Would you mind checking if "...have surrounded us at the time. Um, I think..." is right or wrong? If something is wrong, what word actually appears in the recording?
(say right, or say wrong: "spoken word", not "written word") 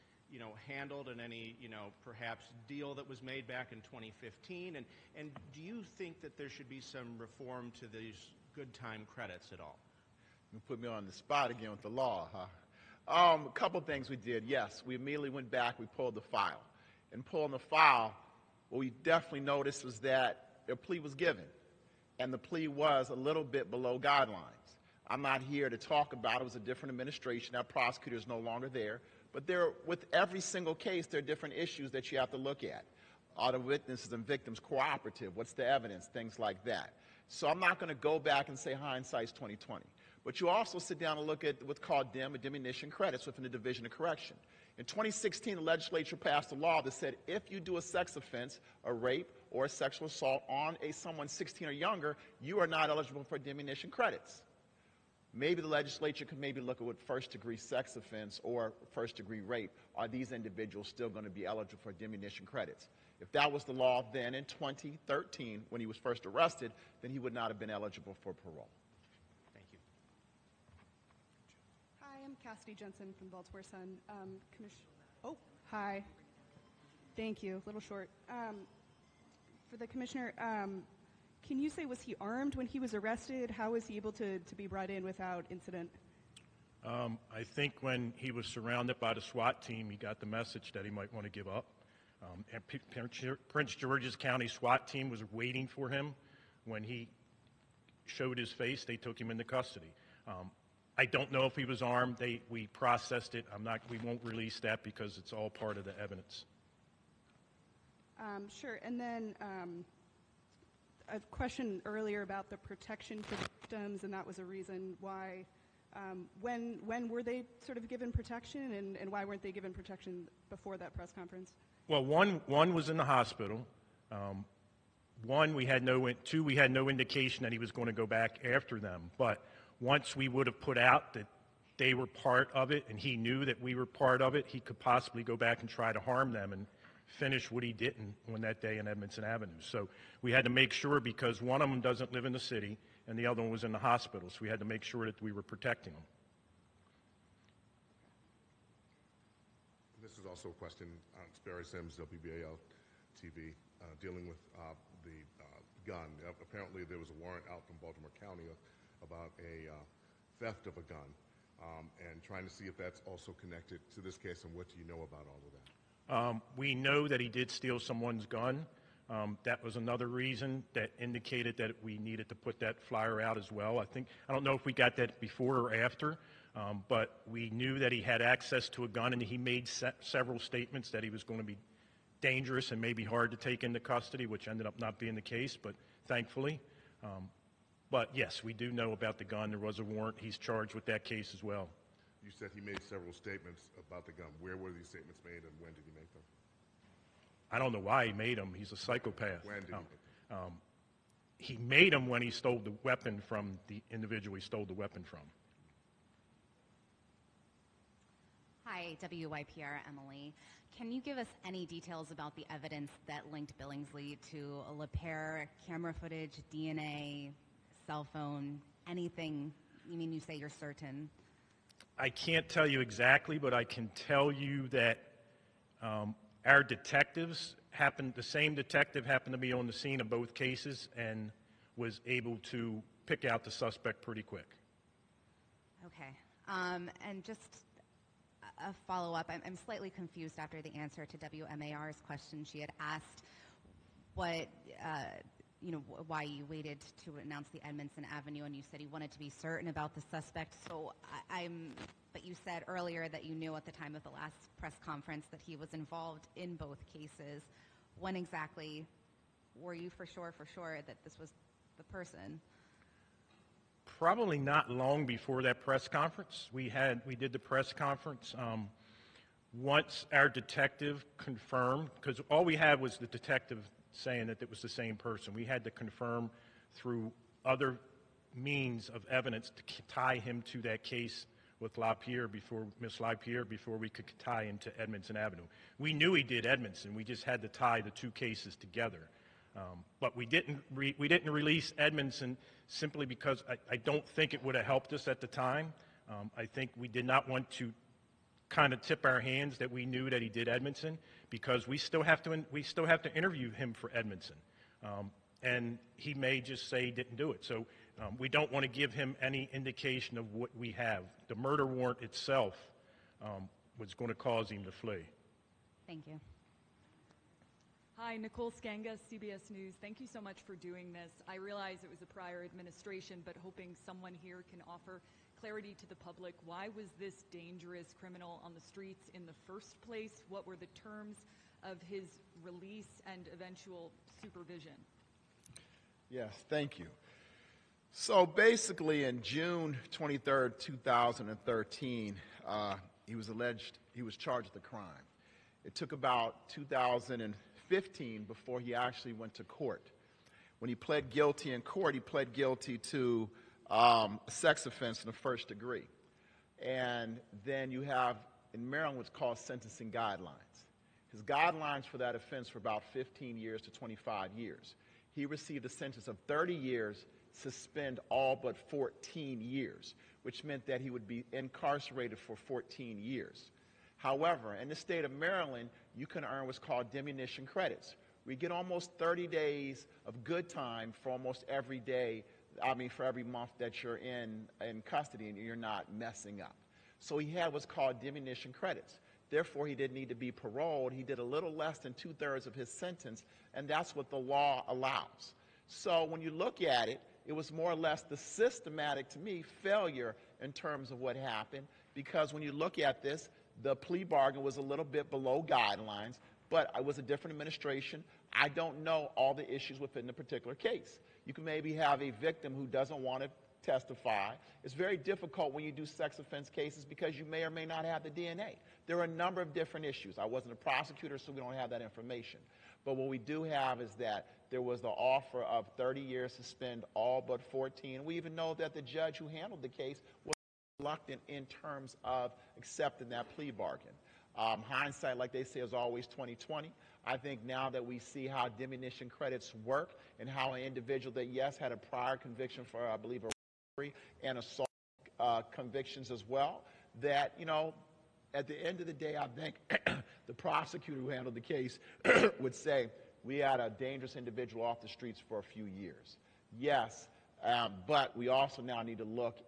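wrong: "helped", not "surrounded".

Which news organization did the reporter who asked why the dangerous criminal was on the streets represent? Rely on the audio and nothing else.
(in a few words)
CBS News.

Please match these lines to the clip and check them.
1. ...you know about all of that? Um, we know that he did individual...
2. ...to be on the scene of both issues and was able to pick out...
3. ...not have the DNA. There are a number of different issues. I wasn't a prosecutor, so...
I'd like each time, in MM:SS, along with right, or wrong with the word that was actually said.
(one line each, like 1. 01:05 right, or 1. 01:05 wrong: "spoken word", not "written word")
1. 02:44 wrong: "steal", not "individual"
2. 03:49 wrong: "cases", not "issues"
3. 06:57 right.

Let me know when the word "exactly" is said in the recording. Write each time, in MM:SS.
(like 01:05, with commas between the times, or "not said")
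03:42, 04:18.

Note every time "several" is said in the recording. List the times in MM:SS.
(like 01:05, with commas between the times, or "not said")
03:00, 03:12.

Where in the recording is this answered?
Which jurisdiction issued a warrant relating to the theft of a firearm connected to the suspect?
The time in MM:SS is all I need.
02:37.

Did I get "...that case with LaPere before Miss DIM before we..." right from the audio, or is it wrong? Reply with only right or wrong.
wrong.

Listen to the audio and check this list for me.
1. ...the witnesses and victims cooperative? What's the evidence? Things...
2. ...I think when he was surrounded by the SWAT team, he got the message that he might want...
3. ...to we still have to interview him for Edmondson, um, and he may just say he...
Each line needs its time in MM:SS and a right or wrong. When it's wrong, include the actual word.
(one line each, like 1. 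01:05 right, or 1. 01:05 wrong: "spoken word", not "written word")
1. 00:33 right
2. 01:27 right
3. 05:02 right.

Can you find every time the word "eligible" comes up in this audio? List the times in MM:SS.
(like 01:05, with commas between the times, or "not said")
00:52, 01:01, 01:07.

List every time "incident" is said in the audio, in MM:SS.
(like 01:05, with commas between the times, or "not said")
01:25.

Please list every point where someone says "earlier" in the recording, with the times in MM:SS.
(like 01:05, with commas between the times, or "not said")
01:51, 04:12.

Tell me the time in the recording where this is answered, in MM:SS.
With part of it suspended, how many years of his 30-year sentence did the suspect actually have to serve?
06:08.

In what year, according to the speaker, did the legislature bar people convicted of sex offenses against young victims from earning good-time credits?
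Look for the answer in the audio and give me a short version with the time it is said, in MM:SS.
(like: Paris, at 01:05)
2016, at 00:44.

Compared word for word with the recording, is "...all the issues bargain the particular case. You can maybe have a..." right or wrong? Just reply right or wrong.
wrong.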